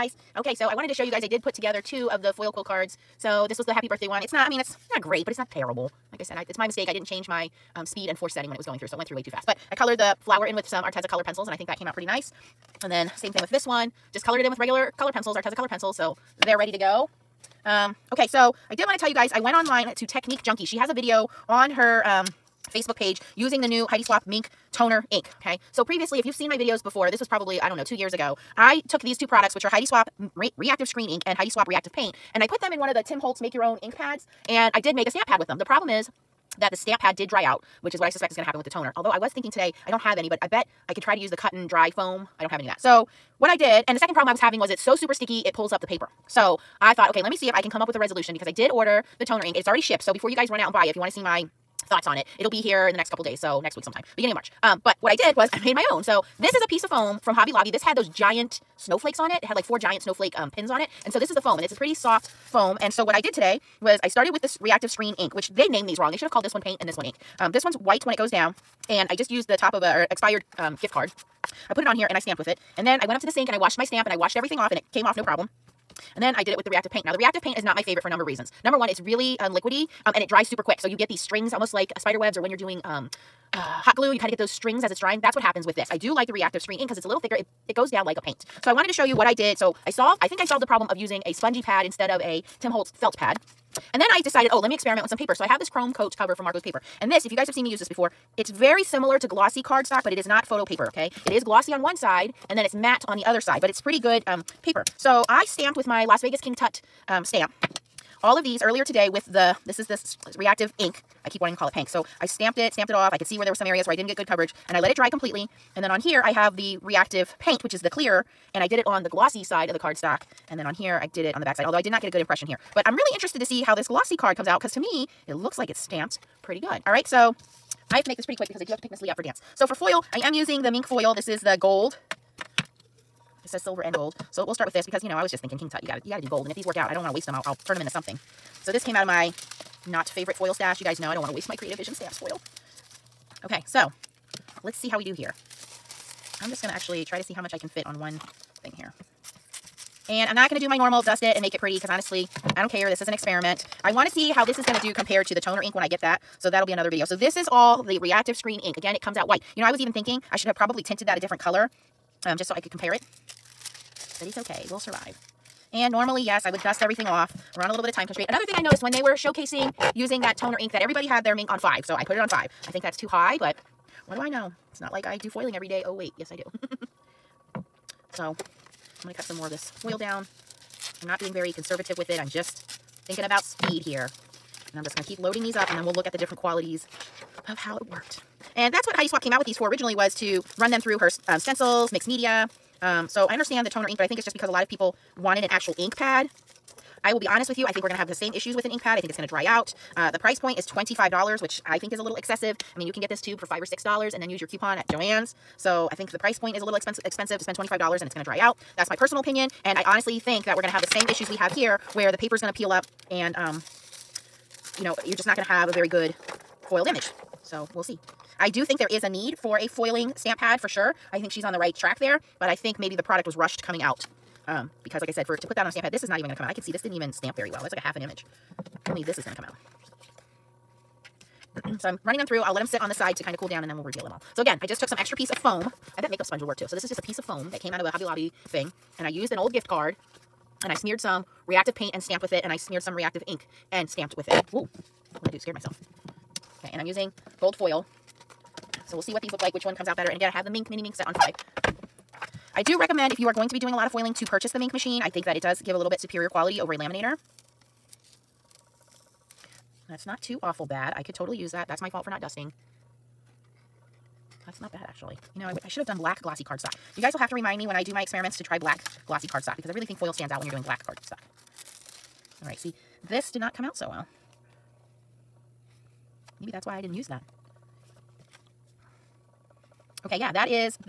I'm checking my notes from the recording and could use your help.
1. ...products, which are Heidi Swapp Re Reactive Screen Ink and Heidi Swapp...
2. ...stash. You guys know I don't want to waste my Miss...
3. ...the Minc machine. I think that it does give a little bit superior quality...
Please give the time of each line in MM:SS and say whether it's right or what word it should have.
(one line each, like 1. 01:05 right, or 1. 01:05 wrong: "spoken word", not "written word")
1. 00:29 right
2. 02:20 wrong: "Creative", not "Miss"
3. 04:14 right.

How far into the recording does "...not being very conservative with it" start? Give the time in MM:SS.
03:01.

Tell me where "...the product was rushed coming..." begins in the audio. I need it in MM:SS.
03:42.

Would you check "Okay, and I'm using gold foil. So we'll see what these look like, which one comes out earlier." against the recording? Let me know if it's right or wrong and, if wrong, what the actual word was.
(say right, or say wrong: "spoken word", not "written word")
wrong: "better", not "earlier".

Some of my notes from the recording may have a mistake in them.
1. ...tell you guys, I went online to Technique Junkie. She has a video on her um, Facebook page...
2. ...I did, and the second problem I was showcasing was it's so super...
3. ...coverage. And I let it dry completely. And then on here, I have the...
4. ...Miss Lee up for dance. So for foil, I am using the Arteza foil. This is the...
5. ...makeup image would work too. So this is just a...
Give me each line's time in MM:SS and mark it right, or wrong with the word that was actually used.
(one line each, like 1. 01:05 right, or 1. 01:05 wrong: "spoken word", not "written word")
1. 00:18 right
2. 00:43 wrong: "having", not "showcasing"
3. 01:54 right
4. 02:08 wrong: "Minc", not "Arteza"
5. 03:56 wrong: "sponge", not "image".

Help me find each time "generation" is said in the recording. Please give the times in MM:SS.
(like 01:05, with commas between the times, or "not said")
not said.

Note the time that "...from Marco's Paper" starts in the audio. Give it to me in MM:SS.
01:36.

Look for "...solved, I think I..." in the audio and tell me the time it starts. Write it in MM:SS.
01:29.